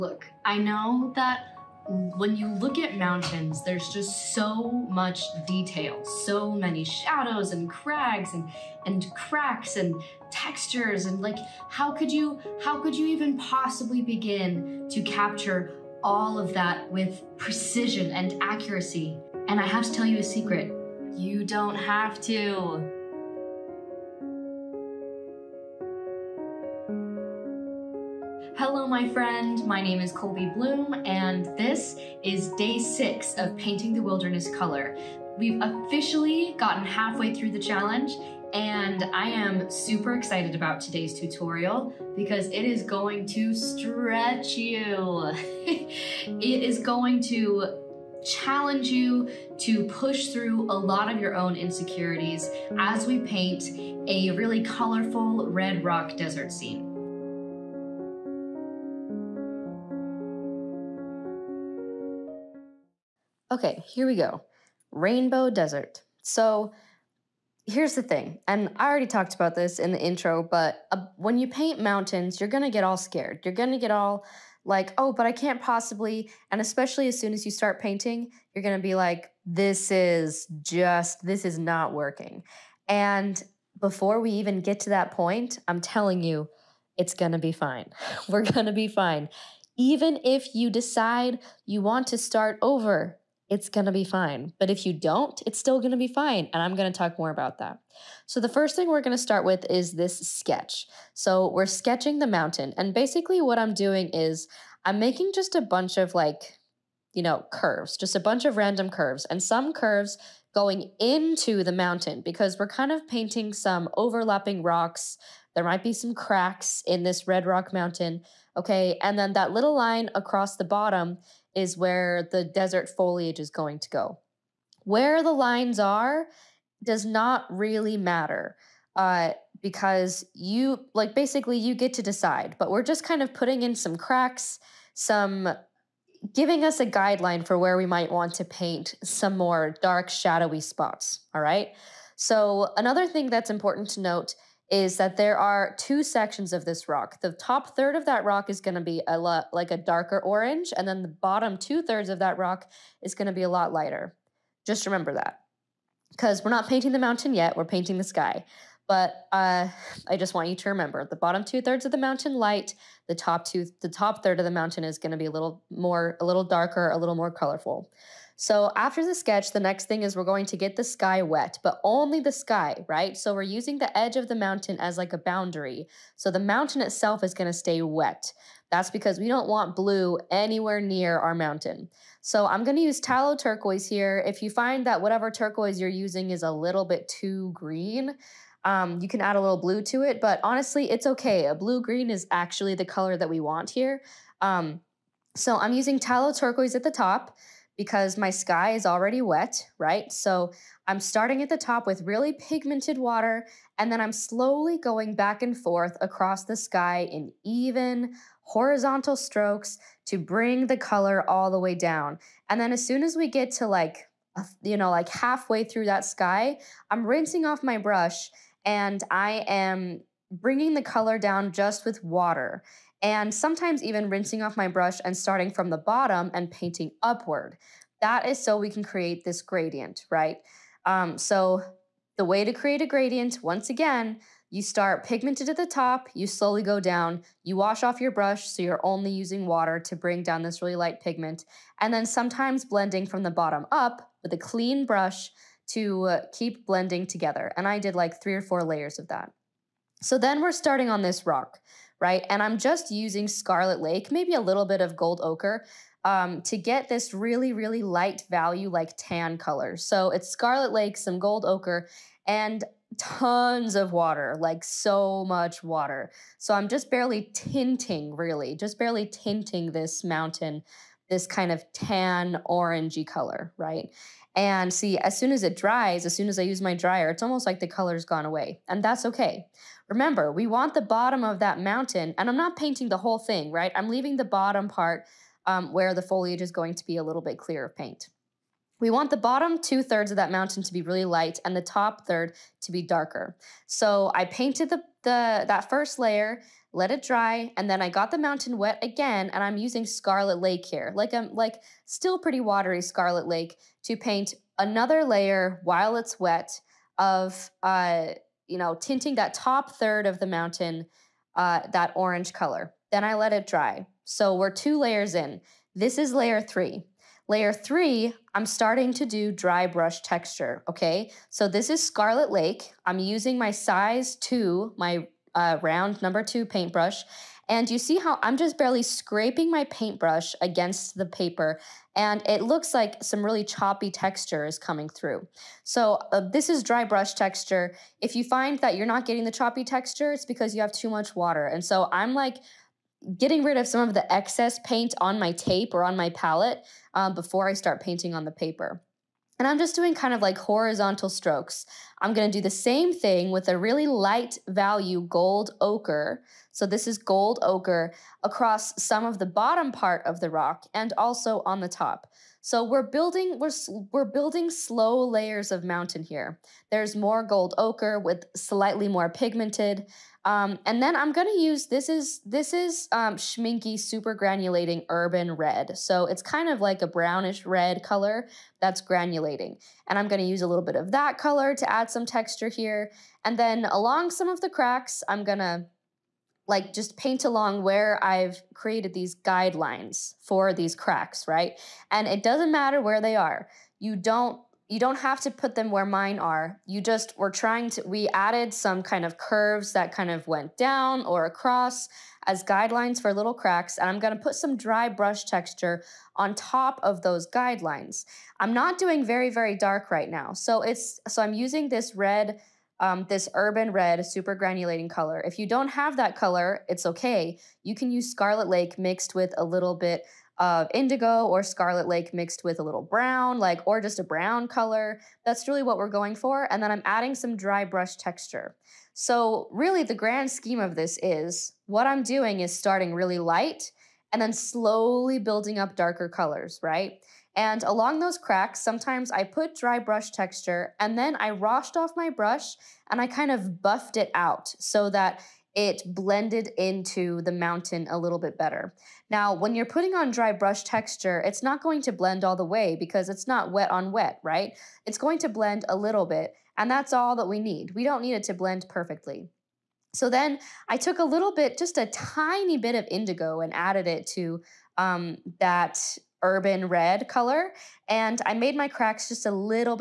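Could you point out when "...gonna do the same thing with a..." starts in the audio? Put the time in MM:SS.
05:52.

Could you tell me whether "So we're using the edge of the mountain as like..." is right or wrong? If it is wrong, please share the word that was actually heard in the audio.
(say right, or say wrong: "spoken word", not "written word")
right.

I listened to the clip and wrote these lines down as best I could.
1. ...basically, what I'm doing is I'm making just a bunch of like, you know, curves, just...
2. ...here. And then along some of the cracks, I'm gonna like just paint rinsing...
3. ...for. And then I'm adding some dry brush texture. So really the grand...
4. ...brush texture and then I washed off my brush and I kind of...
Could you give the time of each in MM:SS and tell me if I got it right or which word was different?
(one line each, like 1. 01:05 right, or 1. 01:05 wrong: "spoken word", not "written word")
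1. 01:42 right
2. 06:22 wrong: "along", not "rinsing"
3. 07:06 right
4. 07:19 right.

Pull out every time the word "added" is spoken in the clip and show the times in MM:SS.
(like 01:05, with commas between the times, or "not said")
06:38, 07:43.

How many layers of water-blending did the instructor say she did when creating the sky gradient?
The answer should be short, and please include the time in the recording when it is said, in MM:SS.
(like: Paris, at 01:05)
3 or 4, at 04:08.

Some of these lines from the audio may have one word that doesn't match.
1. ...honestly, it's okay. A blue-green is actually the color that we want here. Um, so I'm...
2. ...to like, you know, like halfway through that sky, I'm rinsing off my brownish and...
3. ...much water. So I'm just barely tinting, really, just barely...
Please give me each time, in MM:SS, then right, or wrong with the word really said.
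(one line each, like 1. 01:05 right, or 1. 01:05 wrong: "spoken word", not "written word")
1. 03:10 right
2. 03:33 wrong: "brush", not "brownish"
3. 04:25 right.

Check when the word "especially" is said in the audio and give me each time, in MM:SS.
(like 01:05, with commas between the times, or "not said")
01:16.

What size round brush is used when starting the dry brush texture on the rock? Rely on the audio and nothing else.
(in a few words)
Size 2.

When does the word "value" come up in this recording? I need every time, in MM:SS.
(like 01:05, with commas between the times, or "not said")
04:18, 05:54.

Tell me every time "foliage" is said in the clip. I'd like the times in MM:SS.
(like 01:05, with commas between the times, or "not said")
02:02, 04:46.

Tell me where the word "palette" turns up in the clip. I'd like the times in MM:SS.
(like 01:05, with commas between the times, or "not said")
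05:46.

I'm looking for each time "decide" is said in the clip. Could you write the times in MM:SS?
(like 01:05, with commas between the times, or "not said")
01:30, 02:12.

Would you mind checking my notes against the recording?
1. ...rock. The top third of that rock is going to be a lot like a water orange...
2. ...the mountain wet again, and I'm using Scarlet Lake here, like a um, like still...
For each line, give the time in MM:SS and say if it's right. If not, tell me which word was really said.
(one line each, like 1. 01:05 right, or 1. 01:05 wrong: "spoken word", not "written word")
1. 02:26 wrong: "darker", not "water"
2. 04:58 right.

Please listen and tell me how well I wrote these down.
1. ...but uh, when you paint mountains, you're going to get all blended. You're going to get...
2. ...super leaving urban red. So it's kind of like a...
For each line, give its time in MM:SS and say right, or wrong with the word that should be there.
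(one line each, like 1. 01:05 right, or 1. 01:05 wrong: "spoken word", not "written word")
1. 01:10 wrong: "scared", not "blended"
2. 06:13 wrong: "granulating", not "leaving".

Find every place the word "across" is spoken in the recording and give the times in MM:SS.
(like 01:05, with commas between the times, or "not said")
02:00, 03:26, 05:58, 06:41.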